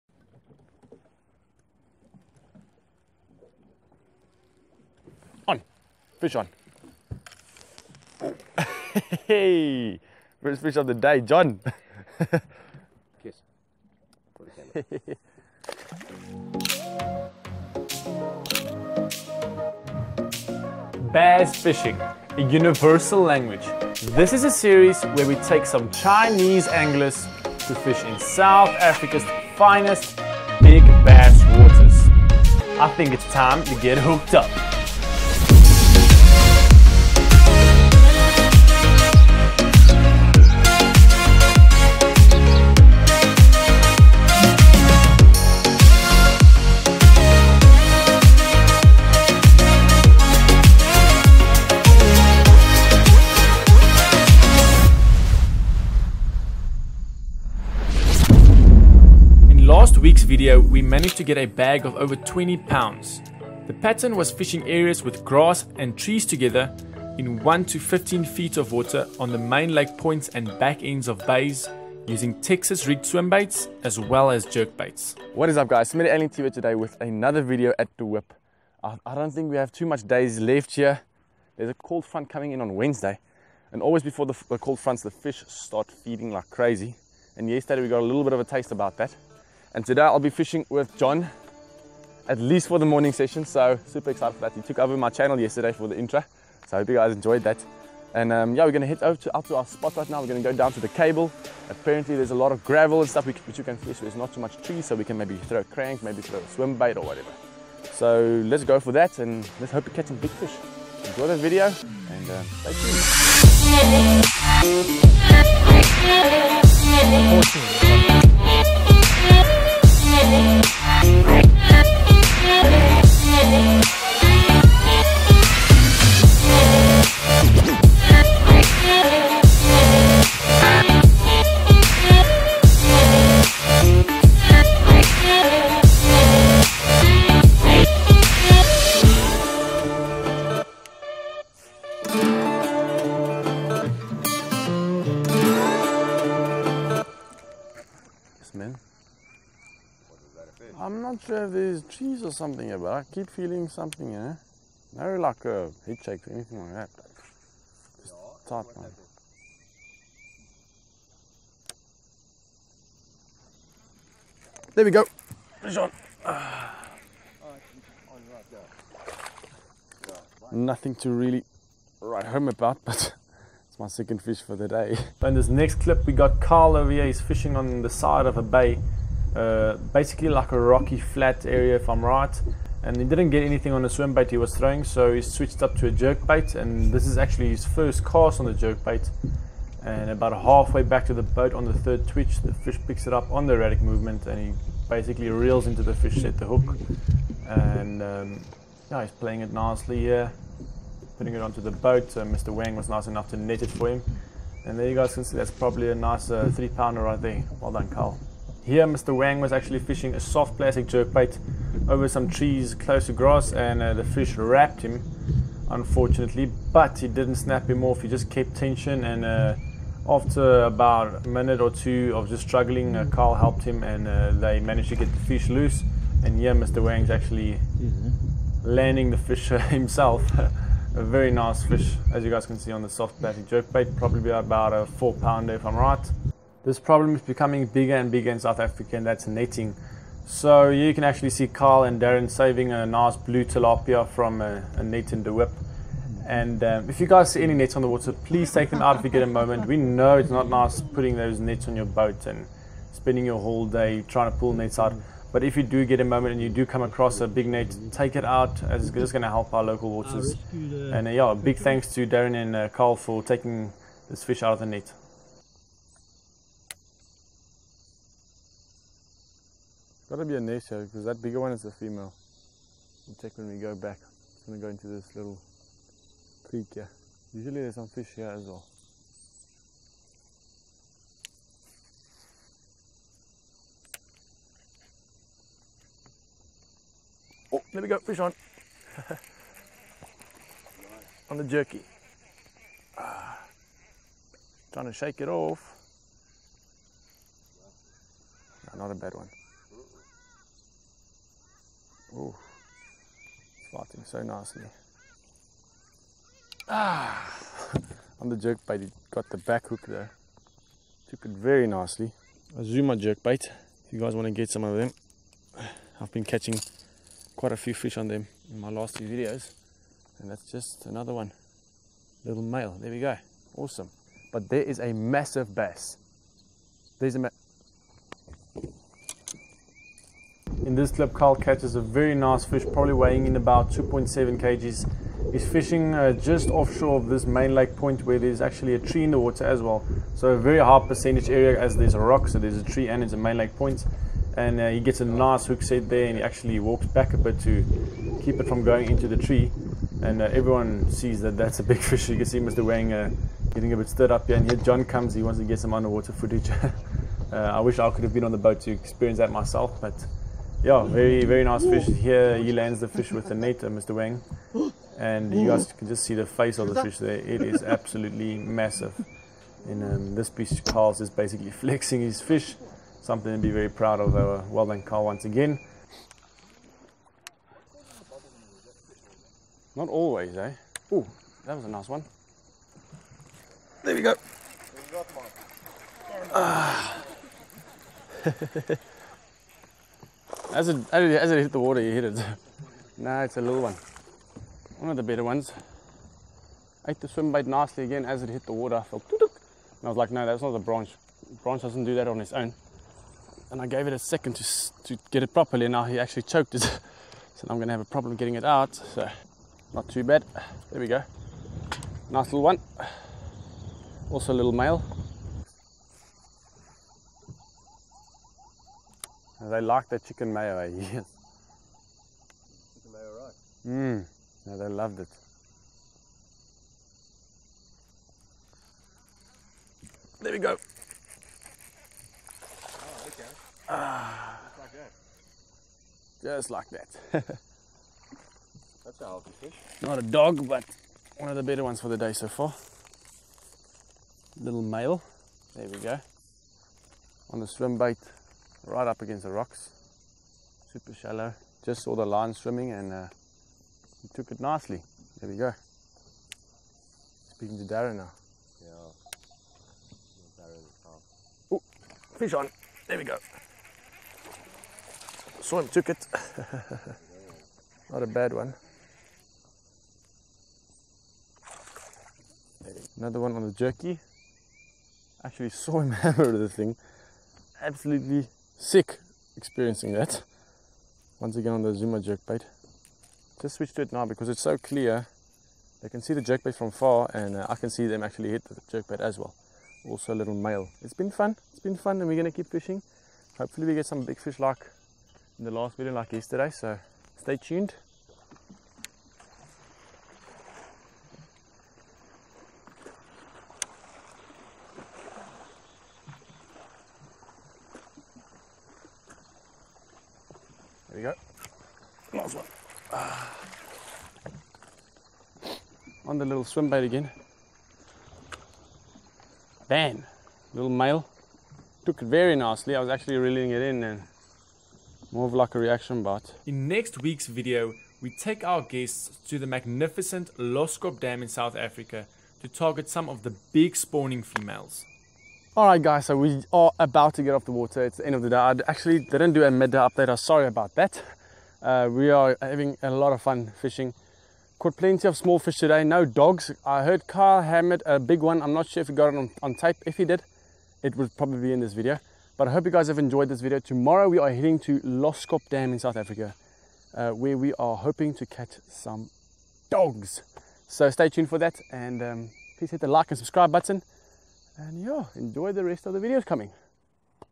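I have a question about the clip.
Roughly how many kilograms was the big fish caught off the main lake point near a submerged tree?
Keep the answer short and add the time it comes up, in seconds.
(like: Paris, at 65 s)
2.7 kg, at 333 s.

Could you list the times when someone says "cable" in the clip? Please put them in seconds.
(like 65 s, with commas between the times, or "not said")
100 s.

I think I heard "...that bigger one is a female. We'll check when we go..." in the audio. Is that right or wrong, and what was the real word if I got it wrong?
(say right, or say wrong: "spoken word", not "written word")
right.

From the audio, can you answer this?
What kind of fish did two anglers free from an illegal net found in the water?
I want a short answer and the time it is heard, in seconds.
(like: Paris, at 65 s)
Blue tilapia, at 243 s.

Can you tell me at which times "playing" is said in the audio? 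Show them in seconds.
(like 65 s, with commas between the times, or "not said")
199 s.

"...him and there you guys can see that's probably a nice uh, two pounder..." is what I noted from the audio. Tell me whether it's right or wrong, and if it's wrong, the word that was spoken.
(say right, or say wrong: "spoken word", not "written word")
wrong: "three", not "two".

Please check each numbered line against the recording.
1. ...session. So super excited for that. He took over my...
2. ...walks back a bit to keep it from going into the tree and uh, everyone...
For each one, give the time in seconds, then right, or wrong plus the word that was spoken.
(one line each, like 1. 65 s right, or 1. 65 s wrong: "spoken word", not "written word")
1. 93 s right
2. 346 s right.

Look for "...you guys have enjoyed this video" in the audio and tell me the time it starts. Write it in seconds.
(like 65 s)
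552 s.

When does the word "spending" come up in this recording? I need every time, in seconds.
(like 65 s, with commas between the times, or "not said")
252 s.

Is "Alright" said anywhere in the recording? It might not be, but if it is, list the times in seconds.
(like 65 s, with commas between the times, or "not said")
535 s.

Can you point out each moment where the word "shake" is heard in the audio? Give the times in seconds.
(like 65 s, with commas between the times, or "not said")
156 s, 294 s.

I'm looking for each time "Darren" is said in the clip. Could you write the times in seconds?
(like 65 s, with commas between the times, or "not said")
241 s, 262 s, 457 s.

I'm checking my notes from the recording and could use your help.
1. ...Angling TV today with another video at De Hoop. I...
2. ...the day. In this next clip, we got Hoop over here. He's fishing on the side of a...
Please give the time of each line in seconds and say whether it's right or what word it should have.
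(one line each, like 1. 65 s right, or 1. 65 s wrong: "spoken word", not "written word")
1. 76 s right
2. 174 s wrong: "Carl", not "Hoop".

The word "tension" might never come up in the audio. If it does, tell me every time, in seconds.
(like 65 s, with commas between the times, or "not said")
218 s.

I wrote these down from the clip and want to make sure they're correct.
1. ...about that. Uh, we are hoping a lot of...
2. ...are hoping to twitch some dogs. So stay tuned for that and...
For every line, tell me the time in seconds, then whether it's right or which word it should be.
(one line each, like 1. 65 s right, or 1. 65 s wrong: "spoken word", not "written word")
1. 540 s wrong: "having", not "hoping"
2. 557 s wrong: "catch", not "twitch".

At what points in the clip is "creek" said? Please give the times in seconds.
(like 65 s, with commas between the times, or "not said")
276 s.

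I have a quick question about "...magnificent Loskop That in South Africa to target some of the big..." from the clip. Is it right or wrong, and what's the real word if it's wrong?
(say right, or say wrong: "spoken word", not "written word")
wrong: "Dam", not "That".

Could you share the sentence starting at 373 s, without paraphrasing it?
Something to be very proud of.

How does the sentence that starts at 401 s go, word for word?
branch doesn't do that on its own.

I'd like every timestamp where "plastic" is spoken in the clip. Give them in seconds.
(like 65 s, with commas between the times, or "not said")
210 s, 233 s.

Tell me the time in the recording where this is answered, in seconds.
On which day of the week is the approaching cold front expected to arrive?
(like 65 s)
82 s.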